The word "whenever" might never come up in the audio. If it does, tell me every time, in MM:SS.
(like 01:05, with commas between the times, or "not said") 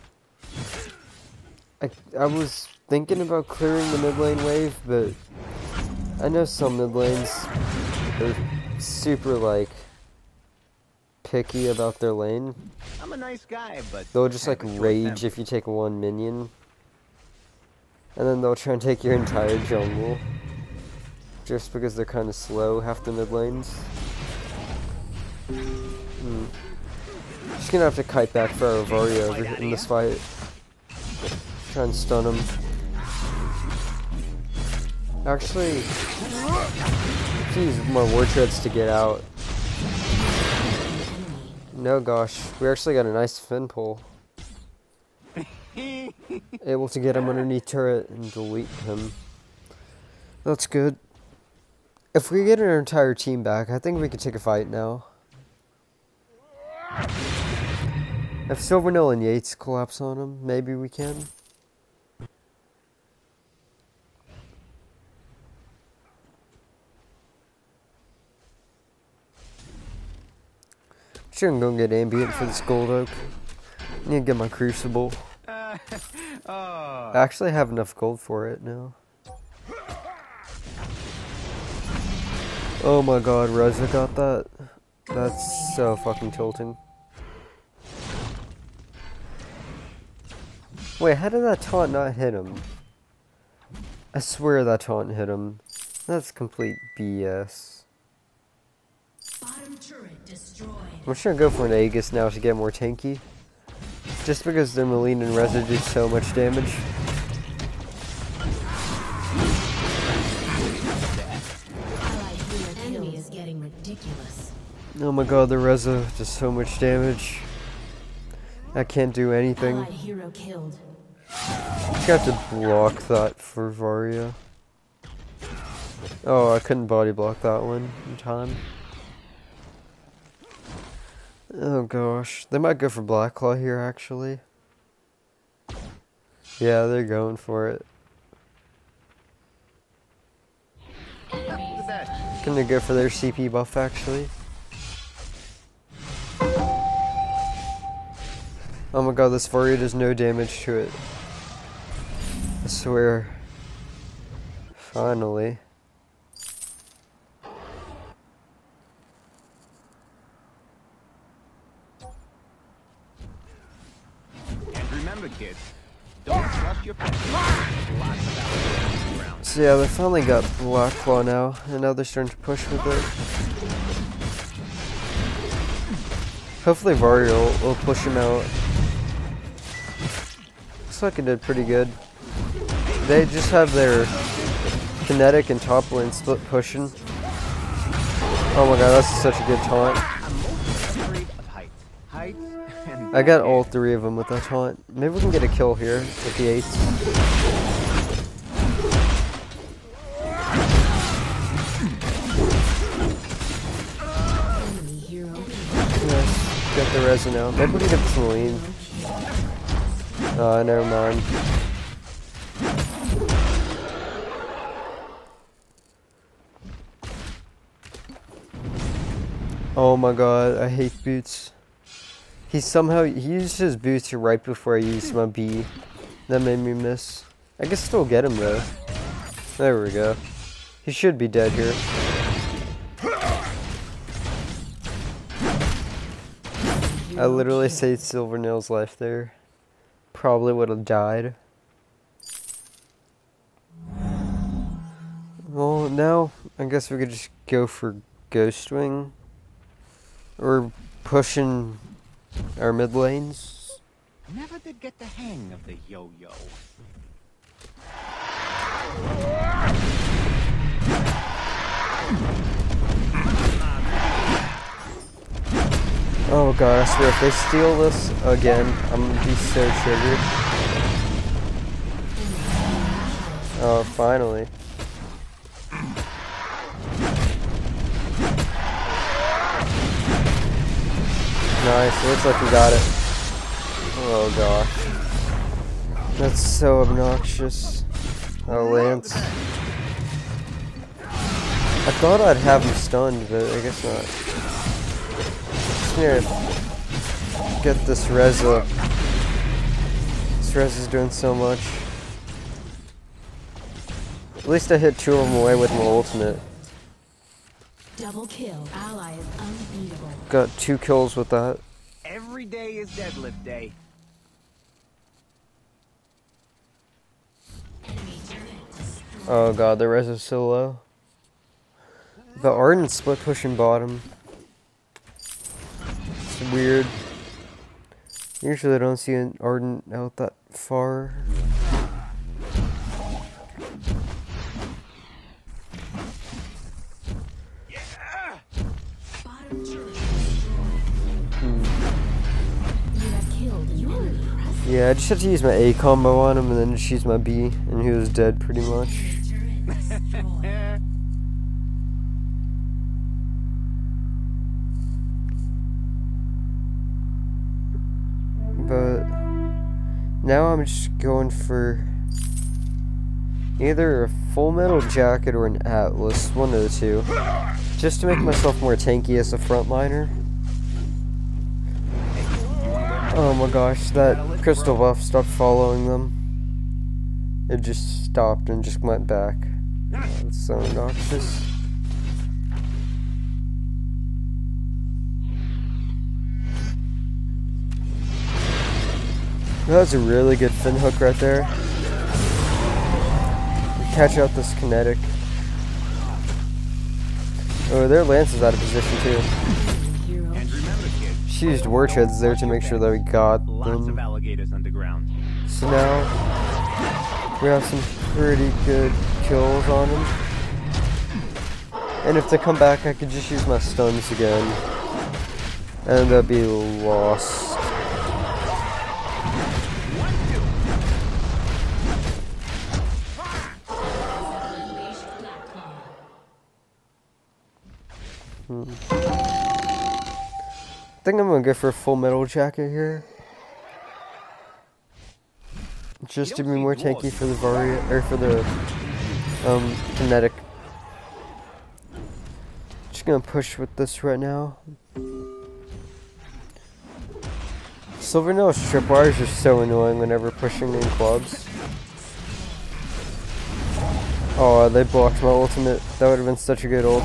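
07:29.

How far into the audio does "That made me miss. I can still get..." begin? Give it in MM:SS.
03:46.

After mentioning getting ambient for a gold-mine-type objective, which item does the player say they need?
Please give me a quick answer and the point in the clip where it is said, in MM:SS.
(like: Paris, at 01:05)
Crucible, at 01:14.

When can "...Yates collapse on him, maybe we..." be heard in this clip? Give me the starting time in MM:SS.
00:59.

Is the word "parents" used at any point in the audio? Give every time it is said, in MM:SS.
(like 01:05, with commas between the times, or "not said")
not said.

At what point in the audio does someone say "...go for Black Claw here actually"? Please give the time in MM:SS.
02:12.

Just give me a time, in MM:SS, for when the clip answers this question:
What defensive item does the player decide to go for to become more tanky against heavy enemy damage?
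01:41.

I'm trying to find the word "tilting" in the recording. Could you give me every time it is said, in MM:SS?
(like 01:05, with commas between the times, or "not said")
01:26.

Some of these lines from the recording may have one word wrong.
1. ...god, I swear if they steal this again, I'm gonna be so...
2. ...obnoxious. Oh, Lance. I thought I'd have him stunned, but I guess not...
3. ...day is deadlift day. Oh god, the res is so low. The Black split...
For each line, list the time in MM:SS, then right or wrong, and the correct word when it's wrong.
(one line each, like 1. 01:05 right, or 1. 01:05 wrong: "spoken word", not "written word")
1. 04:26 right
2. 04:46 right
3. 05:12 wrong: "Ardan", not "Black".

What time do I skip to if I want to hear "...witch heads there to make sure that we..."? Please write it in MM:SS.
06:41.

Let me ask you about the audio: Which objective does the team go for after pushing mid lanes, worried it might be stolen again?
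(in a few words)
Ghostwing.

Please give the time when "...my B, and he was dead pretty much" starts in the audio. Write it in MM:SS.
05:47.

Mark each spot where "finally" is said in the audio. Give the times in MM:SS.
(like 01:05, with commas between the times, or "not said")
02:34, 02:49, 04:33.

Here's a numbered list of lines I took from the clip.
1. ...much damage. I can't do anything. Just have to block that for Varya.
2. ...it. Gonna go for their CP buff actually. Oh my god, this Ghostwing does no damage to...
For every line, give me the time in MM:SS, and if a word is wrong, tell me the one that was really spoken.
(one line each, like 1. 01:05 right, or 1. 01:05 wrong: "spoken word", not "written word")
1. 01:56 right
2. 02:17 wrong: "Varya", not "Ghostwing".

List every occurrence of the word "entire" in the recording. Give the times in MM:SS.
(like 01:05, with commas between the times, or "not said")
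00:19, 00:52.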